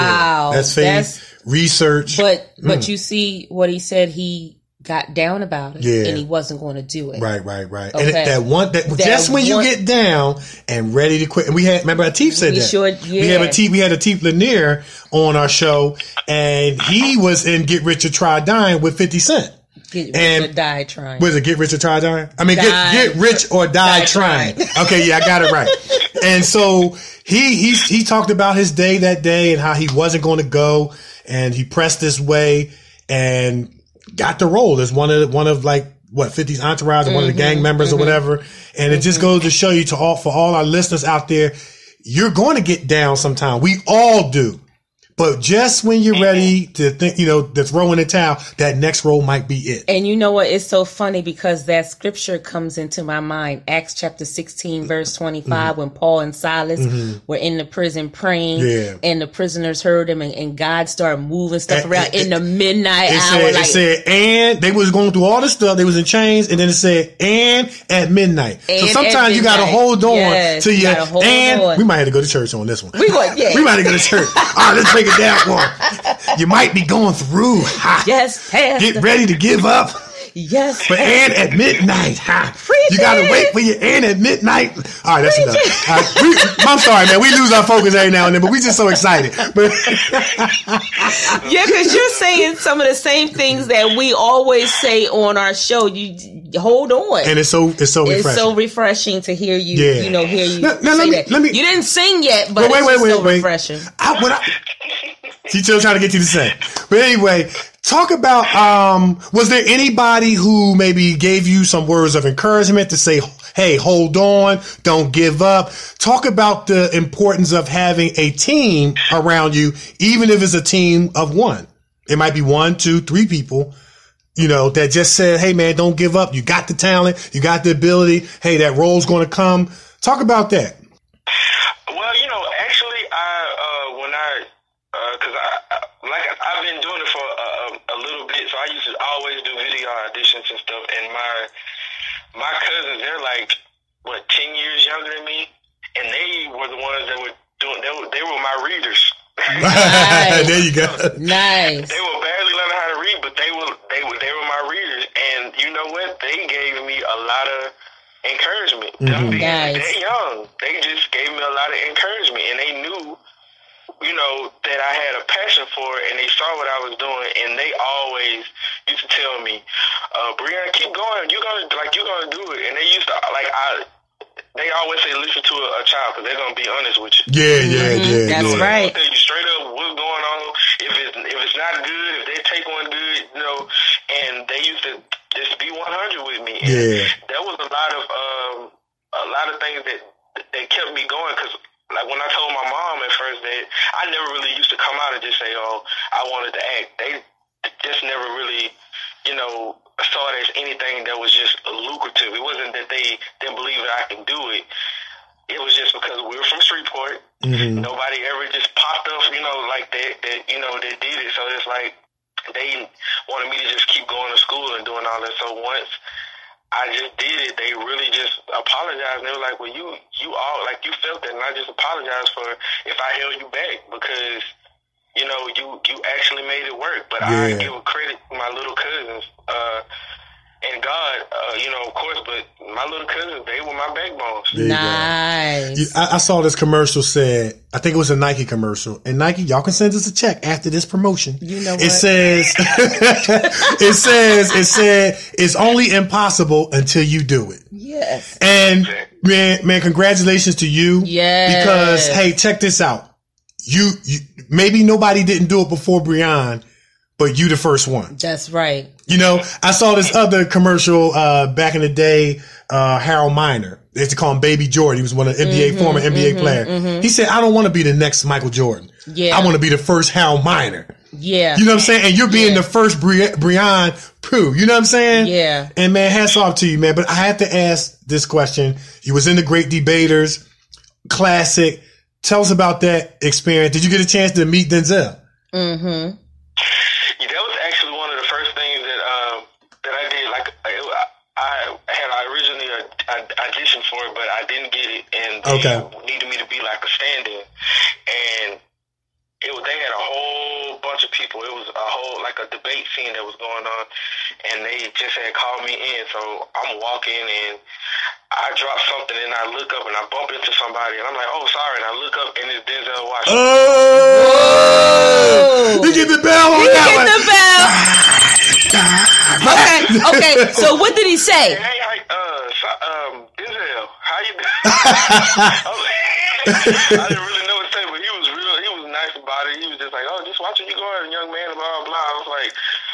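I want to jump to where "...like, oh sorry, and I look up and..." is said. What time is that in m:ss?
5:11.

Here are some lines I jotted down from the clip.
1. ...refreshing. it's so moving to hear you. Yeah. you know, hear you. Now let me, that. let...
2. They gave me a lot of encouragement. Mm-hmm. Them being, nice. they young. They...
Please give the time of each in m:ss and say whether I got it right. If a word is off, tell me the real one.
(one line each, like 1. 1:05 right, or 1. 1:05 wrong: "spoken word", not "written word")
1. 1:38 wrong: "refreshing", not "moving"
2. 2:36 right.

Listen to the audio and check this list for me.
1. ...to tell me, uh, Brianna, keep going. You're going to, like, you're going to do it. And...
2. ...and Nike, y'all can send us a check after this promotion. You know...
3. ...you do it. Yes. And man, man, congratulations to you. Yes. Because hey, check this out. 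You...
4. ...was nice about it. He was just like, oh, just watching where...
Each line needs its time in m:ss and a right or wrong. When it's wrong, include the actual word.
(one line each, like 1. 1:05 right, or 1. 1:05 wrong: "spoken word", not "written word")
1. 2:49 right
2. 3:59 right
3. 4:07 right
4. 5:28 right.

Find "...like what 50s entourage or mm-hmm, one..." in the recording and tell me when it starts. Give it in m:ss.
0:35.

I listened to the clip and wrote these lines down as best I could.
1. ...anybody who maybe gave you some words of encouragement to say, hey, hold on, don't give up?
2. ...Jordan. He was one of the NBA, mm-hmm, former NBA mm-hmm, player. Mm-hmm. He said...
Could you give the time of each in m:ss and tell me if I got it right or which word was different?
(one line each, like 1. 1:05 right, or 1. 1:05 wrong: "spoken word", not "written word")
1. 1:49 right
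2. 4:24 right.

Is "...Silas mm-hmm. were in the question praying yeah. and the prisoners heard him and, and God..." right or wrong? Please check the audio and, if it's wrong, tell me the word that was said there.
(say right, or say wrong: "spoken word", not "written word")
wrong: "prison", not "question".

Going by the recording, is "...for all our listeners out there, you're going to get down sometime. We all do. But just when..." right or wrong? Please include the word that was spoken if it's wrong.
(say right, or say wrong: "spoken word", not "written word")
right.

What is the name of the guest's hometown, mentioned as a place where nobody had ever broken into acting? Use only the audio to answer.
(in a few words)
Shreveport.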